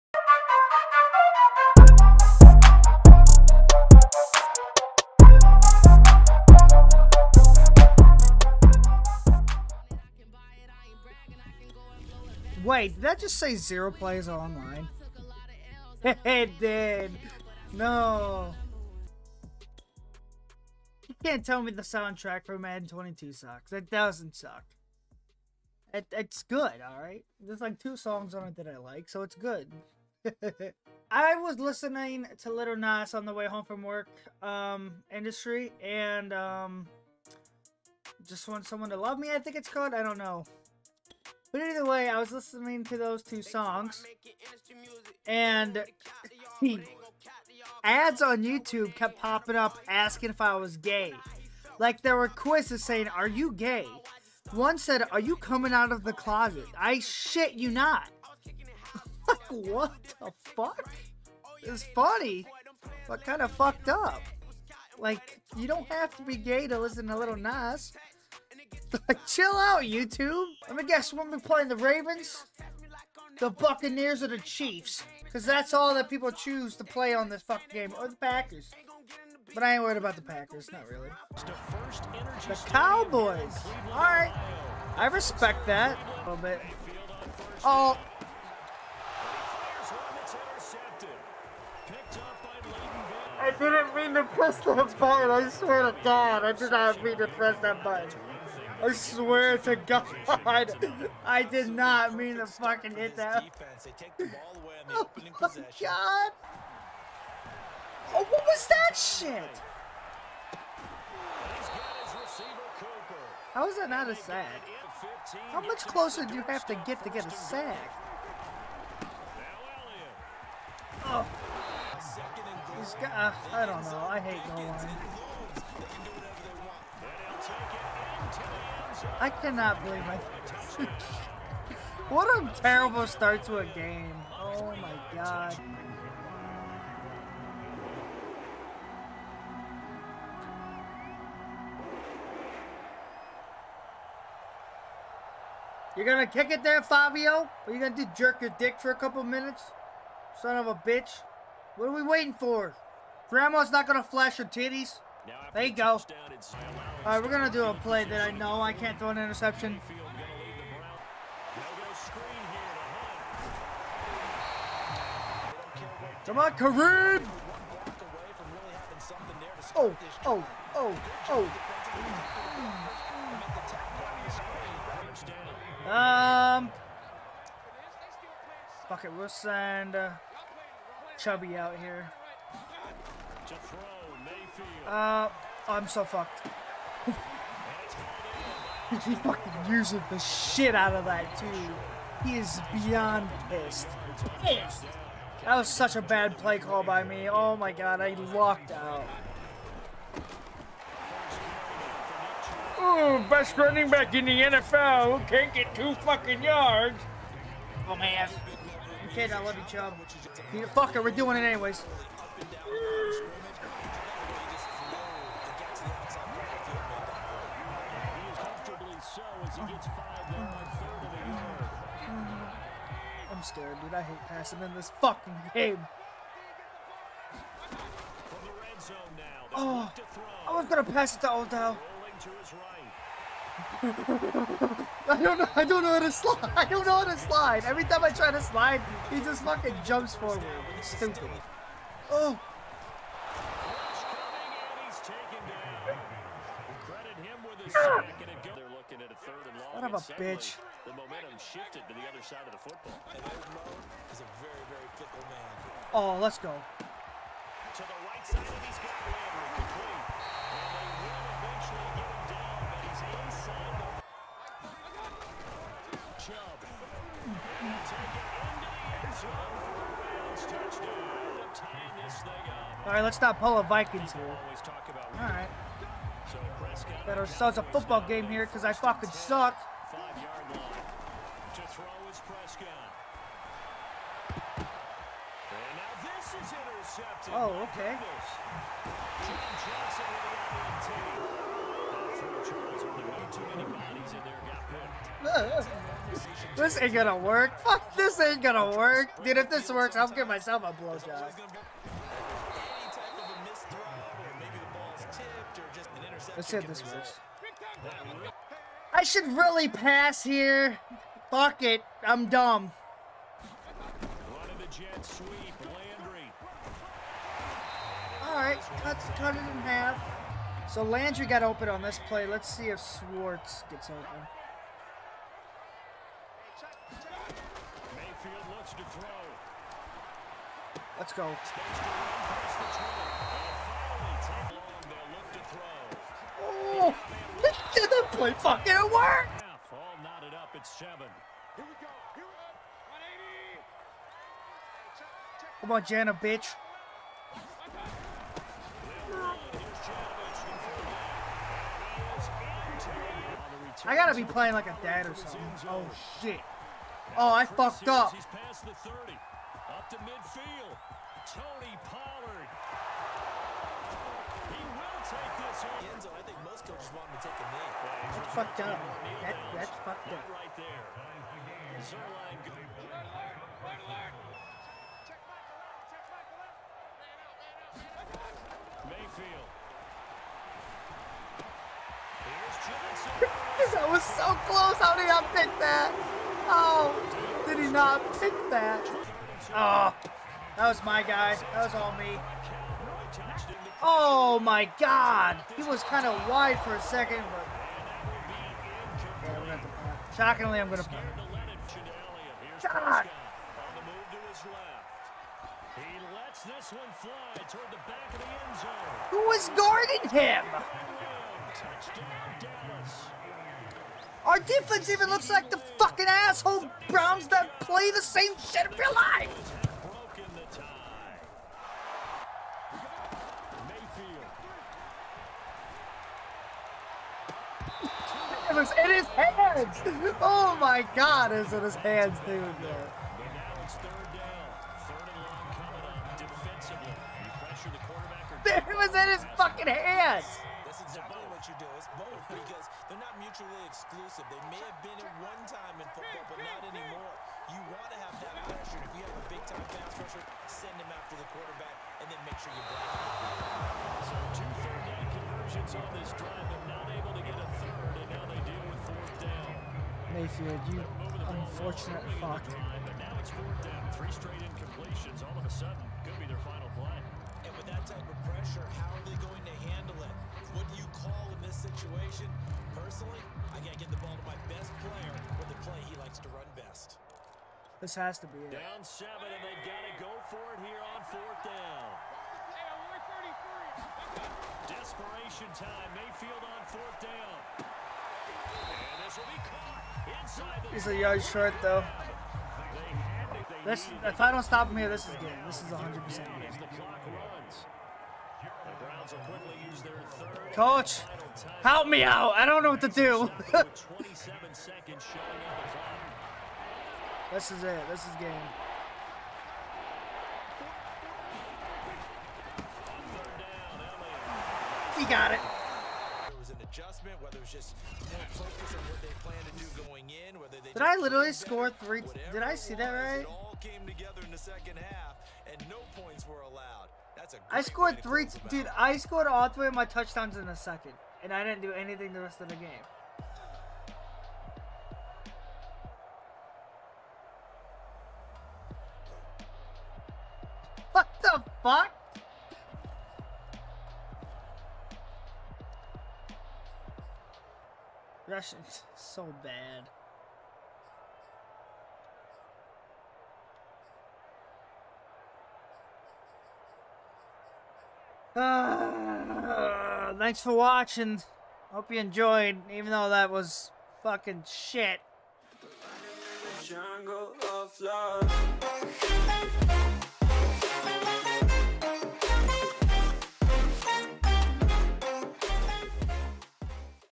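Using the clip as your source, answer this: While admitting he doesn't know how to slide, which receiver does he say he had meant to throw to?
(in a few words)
Odell.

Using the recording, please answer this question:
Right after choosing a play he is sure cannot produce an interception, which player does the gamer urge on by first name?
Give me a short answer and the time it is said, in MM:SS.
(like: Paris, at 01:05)
Kareem, at 02:46.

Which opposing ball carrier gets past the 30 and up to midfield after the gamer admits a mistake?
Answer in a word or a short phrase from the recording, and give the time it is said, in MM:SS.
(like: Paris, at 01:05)
Tony Pollard, at 06:01.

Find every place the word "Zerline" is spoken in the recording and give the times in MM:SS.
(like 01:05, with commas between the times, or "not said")
06:11.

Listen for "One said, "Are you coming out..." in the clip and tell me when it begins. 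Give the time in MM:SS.
00:54.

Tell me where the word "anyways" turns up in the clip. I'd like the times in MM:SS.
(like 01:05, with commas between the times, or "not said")
03:31.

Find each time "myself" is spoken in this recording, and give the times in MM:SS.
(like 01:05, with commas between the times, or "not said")
05:00.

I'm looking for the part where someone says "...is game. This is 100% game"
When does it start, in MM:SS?
08:15.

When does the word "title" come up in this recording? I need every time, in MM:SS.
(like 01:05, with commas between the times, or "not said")
not said.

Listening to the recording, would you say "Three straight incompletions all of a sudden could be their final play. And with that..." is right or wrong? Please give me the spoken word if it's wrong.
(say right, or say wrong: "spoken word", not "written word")
right.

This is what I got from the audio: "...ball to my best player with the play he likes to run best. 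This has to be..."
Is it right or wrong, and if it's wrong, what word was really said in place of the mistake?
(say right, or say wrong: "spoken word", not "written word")
right.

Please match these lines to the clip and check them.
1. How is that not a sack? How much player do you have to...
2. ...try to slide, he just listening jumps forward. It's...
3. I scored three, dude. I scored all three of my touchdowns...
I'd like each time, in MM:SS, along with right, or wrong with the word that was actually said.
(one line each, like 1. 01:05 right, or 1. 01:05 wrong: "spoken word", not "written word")
1. 01:53 wrong: "closer", not "player"
2. 03:58 wrong: "fucking", not "listening"
3. 08:47 right.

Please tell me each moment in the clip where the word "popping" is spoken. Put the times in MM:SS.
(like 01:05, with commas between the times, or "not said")
00:49.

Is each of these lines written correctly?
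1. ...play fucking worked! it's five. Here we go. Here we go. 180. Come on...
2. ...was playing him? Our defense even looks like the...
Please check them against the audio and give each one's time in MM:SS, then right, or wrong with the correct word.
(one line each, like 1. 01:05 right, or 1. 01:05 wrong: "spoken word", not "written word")
1. 05:38 wrong: "seven", not "five"
2. 06:49 wrong: "guarding", not "playing".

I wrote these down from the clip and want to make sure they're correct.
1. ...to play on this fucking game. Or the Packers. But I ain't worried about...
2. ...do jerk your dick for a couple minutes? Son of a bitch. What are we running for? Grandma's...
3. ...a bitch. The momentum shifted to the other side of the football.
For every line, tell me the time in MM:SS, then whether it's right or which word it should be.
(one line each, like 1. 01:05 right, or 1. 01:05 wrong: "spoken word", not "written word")
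1. 01:16 right
2. 02:27 wrong: "waiting", not "running"
3. 04:09 right.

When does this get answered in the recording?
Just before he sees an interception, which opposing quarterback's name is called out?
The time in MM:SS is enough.
04:42.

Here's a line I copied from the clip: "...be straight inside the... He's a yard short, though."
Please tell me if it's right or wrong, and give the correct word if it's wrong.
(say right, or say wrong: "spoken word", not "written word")
wrong: "caught", not "straight".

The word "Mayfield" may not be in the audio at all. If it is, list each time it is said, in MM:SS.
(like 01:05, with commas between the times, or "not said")
06:18, 07:40, 08:05.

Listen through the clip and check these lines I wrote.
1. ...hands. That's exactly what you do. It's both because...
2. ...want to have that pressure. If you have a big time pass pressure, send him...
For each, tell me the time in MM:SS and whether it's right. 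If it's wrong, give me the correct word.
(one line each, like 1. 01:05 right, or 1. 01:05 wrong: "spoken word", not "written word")
1. 07:19 right
2. 07:27 right.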